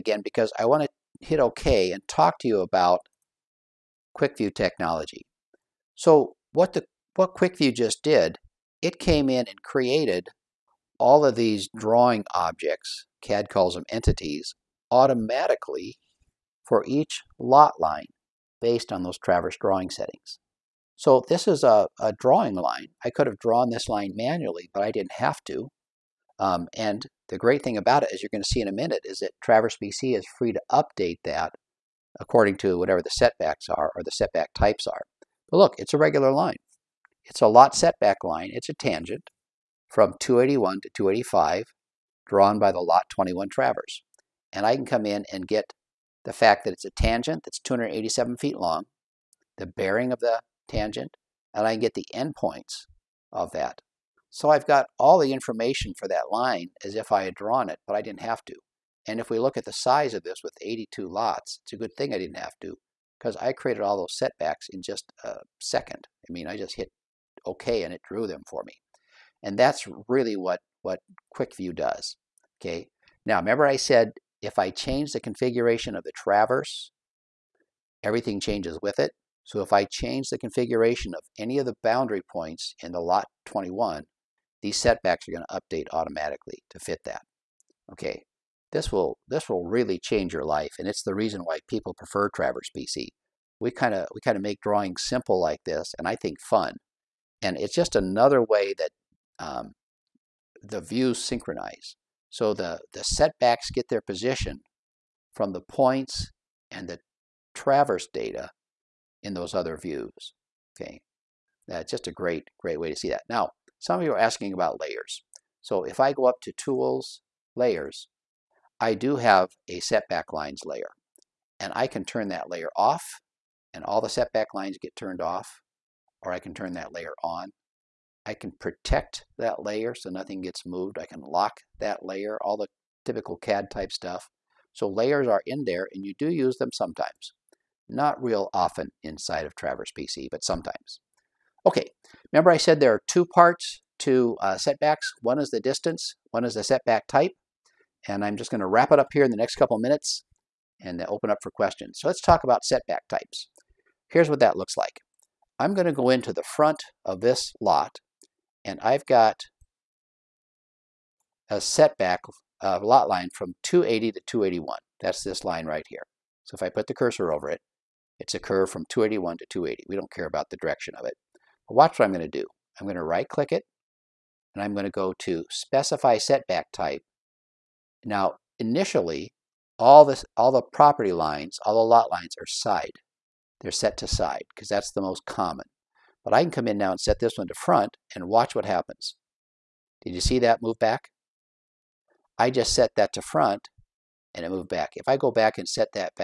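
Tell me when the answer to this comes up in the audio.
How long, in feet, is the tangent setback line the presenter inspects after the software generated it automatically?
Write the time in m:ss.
0:47.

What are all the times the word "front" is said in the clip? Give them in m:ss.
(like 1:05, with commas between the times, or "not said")
2:36, 3:07, 3:13.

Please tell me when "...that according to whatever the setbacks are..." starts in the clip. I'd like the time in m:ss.
0:31.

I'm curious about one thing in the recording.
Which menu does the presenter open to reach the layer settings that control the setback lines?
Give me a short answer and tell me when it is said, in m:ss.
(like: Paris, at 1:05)
Tools, at 1:56.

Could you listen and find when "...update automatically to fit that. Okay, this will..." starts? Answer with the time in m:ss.
1:25.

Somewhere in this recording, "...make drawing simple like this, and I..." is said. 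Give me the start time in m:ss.
1:34.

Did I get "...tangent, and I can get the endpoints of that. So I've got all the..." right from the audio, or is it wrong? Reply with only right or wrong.
right.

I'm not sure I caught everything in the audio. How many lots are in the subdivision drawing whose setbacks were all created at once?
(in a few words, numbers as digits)
82.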